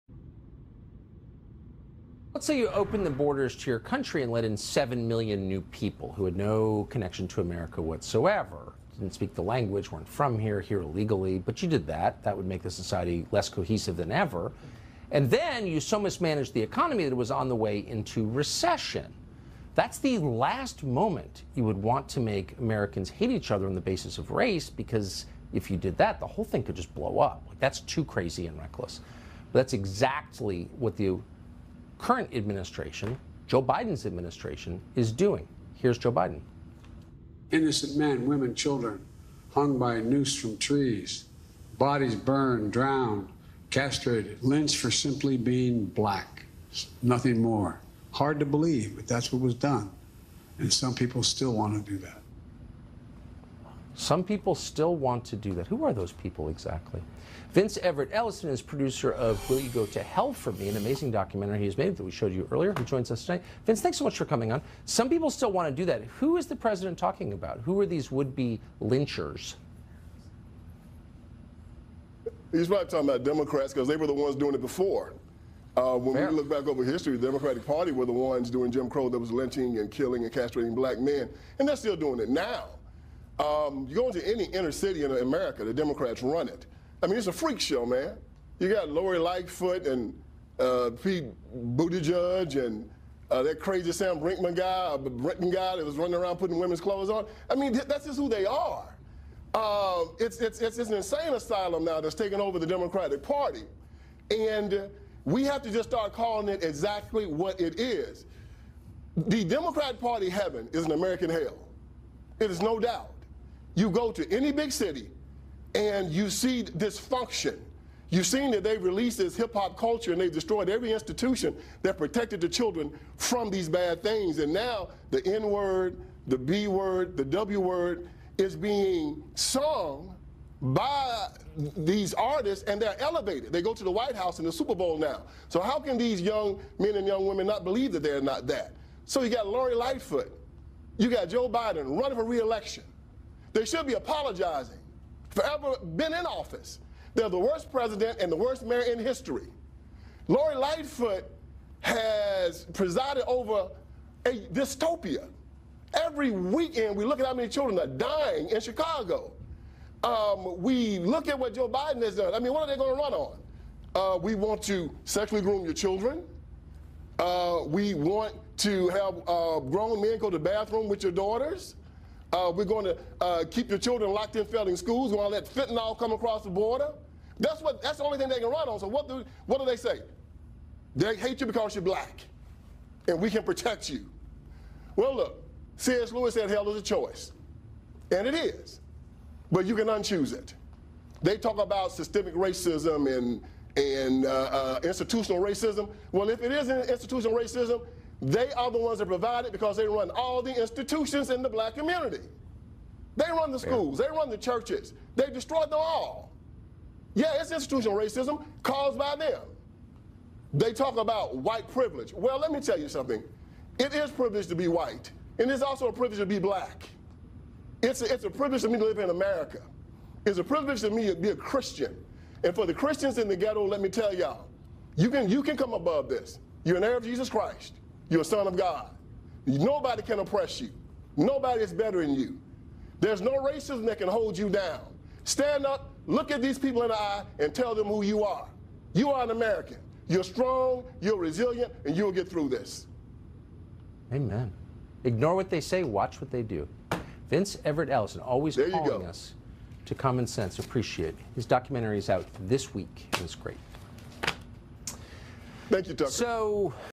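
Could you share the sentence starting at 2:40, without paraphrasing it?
Um, we look at what Joe Biden has done.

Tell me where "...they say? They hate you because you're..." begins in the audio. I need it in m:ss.
2:59.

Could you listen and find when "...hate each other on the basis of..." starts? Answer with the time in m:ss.
0:23.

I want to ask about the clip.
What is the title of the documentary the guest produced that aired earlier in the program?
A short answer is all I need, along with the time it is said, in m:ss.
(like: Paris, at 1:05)
Will You Go to Hell for Me, at 0:59.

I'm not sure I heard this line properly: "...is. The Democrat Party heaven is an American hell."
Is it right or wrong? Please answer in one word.
right.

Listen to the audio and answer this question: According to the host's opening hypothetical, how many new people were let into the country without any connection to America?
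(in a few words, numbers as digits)
7 million.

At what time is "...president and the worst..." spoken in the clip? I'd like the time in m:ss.
2:27.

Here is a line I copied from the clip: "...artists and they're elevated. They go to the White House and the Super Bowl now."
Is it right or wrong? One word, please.
right.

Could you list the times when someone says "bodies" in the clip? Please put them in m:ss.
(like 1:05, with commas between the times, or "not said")
0:41.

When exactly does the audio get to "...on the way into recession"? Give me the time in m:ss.
0:17.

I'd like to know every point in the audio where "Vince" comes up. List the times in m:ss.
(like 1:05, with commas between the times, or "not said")
0:57, 1:03, 4:07.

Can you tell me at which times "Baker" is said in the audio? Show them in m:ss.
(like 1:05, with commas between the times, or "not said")
not said.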